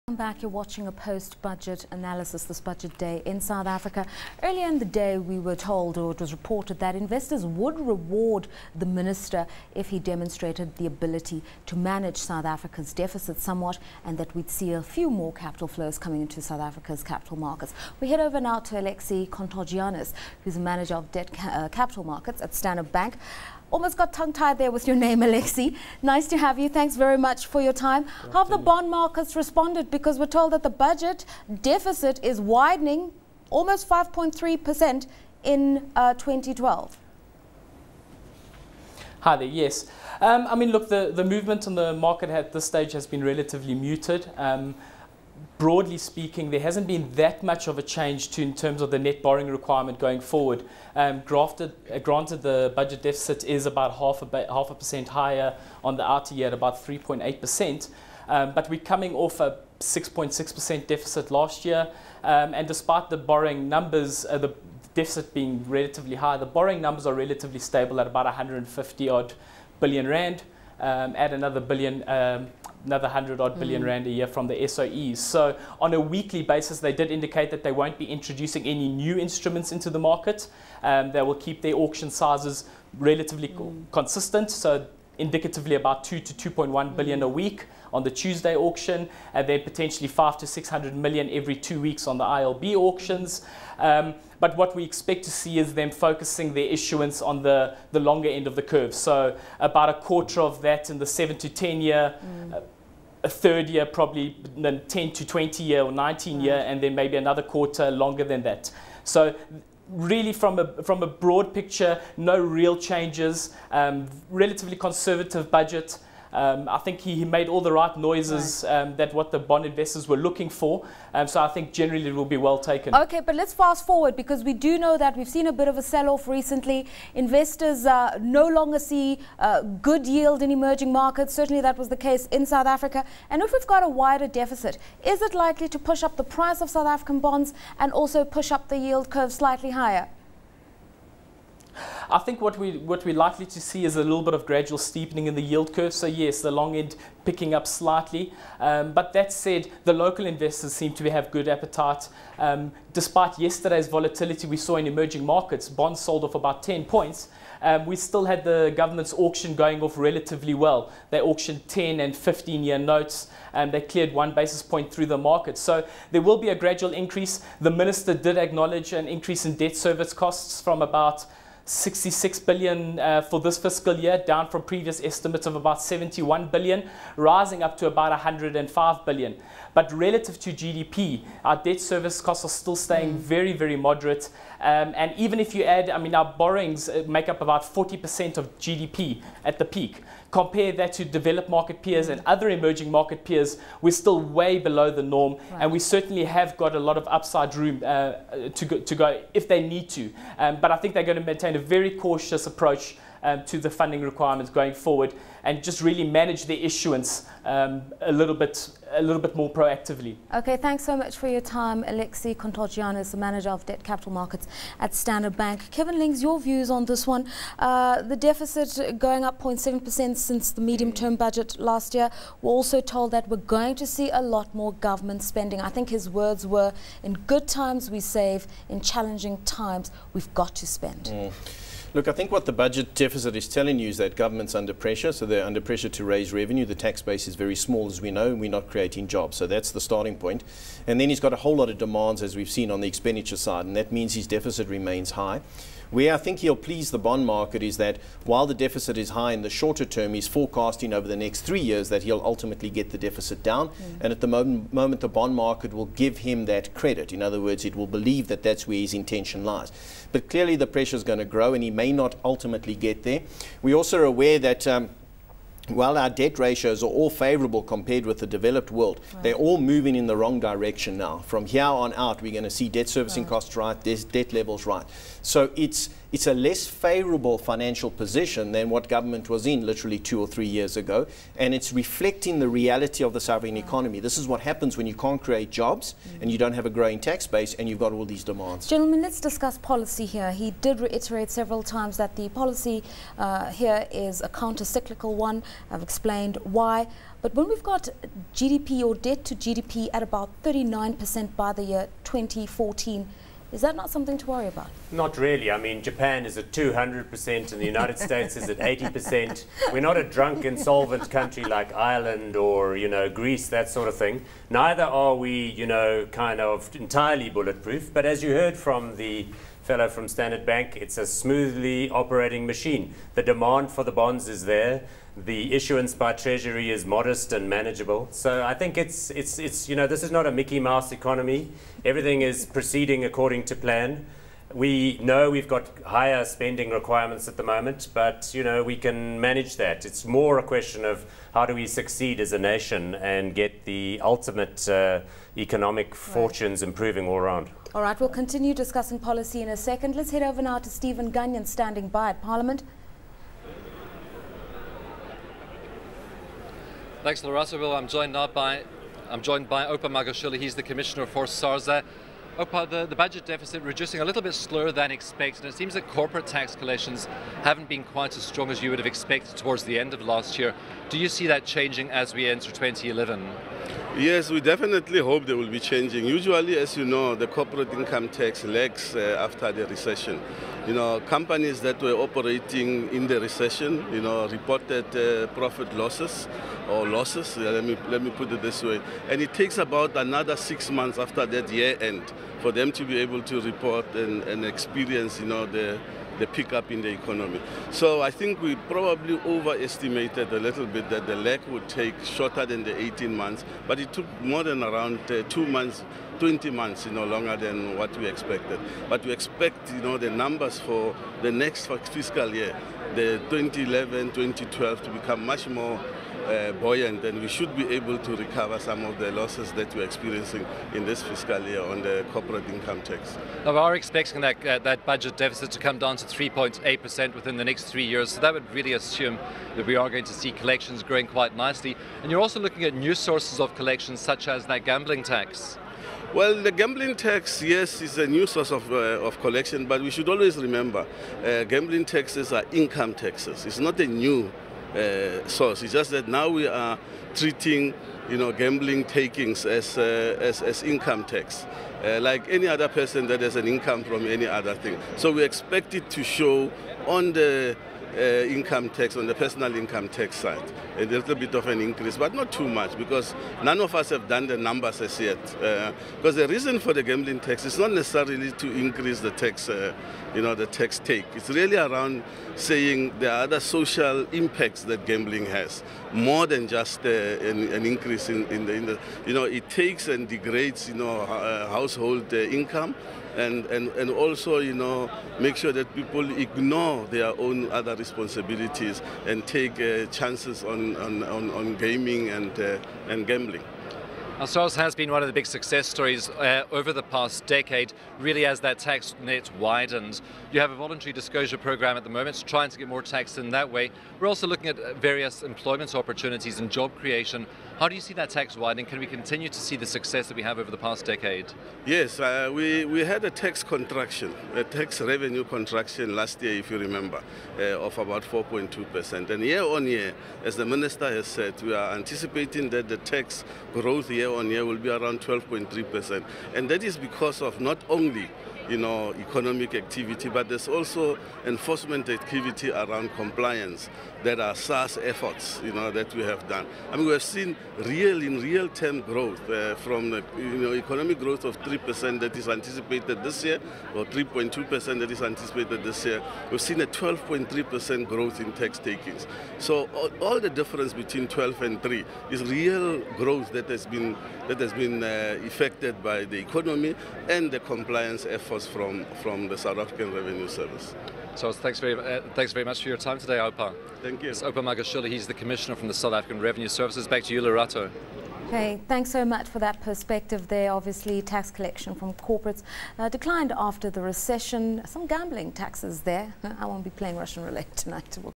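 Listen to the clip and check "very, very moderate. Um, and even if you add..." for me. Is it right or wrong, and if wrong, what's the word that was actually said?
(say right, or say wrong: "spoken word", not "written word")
right.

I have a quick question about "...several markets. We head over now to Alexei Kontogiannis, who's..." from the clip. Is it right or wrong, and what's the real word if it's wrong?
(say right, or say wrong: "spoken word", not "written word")
wrong: "capital", not "several".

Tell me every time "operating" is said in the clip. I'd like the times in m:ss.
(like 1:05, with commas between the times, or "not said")
5:21, 6:21.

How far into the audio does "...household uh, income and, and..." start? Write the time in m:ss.
8:01.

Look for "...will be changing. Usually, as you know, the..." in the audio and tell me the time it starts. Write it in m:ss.
6:15.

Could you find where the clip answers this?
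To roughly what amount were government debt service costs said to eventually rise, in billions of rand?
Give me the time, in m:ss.
2:58.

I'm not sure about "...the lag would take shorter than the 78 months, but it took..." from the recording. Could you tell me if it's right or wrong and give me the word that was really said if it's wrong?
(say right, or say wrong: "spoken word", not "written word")
wrong: "18", not "78".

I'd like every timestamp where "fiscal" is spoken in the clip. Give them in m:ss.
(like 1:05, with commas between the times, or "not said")
2:53, 6:51, 7:01.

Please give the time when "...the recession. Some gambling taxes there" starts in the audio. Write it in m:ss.
9:33.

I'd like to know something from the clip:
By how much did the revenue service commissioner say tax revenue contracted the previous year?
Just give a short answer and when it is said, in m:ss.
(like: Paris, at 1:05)
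4.2%, at 8:38.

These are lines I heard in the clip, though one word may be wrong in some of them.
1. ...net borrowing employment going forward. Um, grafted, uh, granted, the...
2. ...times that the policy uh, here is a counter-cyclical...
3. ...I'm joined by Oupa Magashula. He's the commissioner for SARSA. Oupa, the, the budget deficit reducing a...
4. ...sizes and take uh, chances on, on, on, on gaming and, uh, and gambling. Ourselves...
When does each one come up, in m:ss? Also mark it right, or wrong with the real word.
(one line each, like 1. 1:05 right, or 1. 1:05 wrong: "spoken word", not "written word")
1. 0:48 wrong: "requirement", not "employment"
2. 4:51 right
3. 5:59 right
4. 8:07 wrong: "responsibilities", not "sizes".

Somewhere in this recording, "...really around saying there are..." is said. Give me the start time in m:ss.
7:51.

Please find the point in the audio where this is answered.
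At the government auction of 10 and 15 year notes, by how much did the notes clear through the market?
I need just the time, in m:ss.
2:44.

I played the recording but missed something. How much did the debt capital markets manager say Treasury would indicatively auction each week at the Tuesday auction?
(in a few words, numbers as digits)
2 to 2.1 billion.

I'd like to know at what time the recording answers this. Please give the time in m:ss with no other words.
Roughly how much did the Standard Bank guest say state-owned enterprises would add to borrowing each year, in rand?
1:13.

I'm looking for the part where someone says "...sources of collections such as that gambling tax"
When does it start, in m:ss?
7:12.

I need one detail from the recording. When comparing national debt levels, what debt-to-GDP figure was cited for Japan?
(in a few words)
200%.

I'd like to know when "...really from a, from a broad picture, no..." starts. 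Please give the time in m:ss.
1:49.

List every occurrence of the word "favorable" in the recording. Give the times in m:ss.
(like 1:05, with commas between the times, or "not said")
4:27, 4:36.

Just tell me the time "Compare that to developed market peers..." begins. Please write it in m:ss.
3:10.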